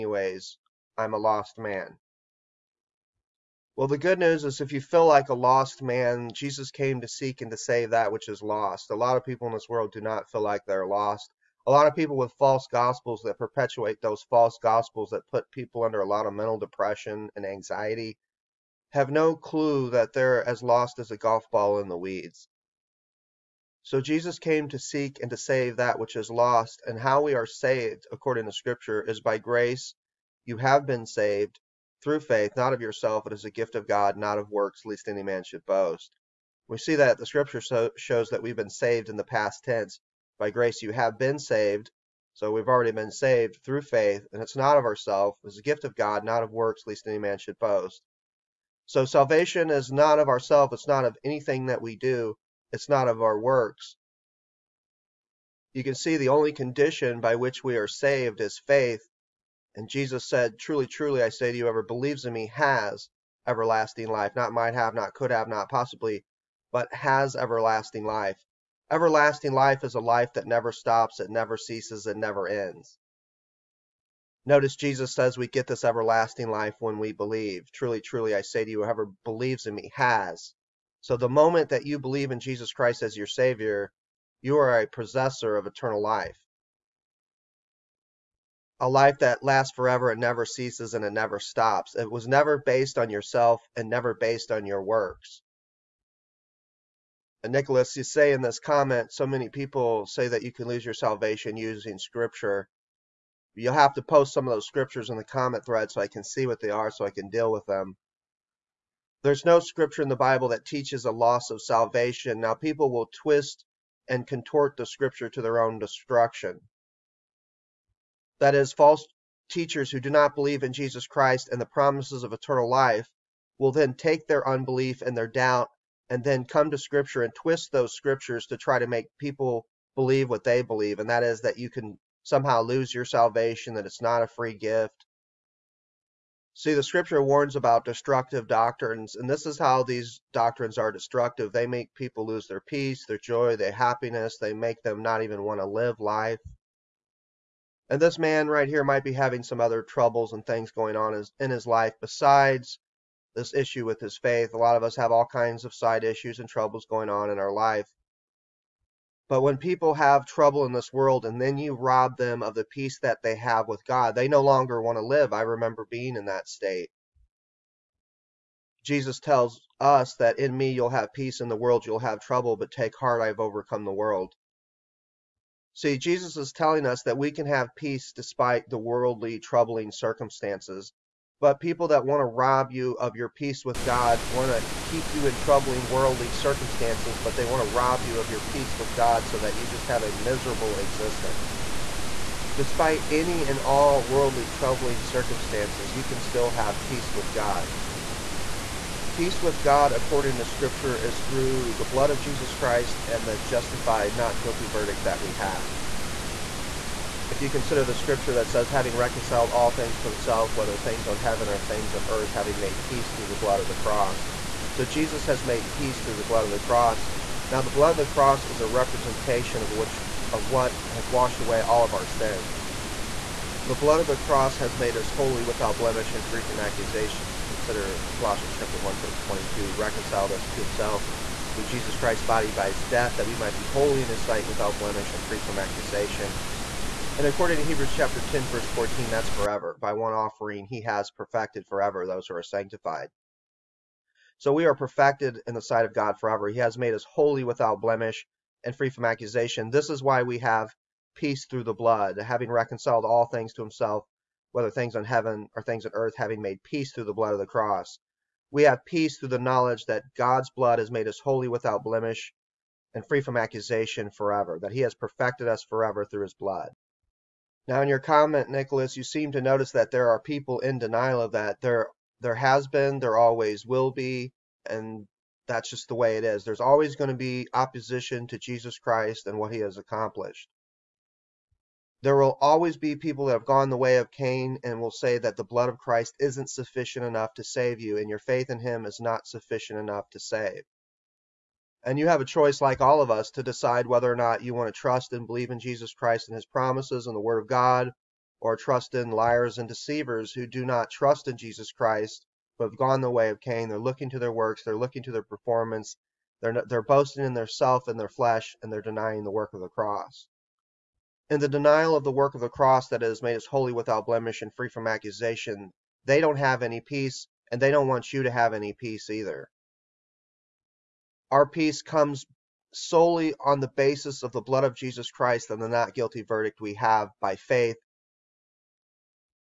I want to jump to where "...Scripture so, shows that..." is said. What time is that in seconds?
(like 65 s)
37 s.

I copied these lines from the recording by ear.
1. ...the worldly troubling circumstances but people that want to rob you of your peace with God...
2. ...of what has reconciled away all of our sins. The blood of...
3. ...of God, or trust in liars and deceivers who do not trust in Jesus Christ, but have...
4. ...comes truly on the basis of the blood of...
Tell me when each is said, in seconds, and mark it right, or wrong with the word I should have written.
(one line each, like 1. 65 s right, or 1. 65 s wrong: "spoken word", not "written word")
1. 178 s right
2. 220 s wrong: "washed", not "reconciled"
3. 297 s right
4. 321 s wrong: "solely", not "truly".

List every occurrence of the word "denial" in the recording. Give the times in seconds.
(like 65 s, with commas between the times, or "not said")
270 s, 311 s.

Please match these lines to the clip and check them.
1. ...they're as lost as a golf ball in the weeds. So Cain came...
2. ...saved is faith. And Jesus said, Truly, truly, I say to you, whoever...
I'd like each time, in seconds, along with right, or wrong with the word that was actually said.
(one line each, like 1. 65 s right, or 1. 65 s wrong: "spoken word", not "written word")
1. 20 s wrong: "Jesus", not "Cain"
2. 57 s right.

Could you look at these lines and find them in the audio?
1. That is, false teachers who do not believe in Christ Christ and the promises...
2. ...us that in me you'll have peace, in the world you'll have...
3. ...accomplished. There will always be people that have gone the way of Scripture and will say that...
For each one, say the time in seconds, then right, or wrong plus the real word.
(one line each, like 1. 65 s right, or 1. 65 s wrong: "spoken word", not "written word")
1. 118 s wrong: "Jesus", not "Christ"
2. 169 s right
3. 279 s wrong: "Cain", not "Scripture".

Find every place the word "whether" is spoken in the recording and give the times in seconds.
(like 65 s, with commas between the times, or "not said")
210 s, 254 s, 293 s.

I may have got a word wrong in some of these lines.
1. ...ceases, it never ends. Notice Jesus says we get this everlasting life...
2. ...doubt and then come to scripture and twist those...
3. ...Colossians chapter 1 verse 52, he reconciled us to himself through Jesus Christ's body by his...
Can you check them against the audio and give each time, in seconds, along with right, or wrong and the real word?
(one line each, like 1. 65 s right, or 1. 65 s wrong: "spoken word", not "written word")
1. 71 s right
2. 125 s right
3. 228 s wrong: "22", not "52".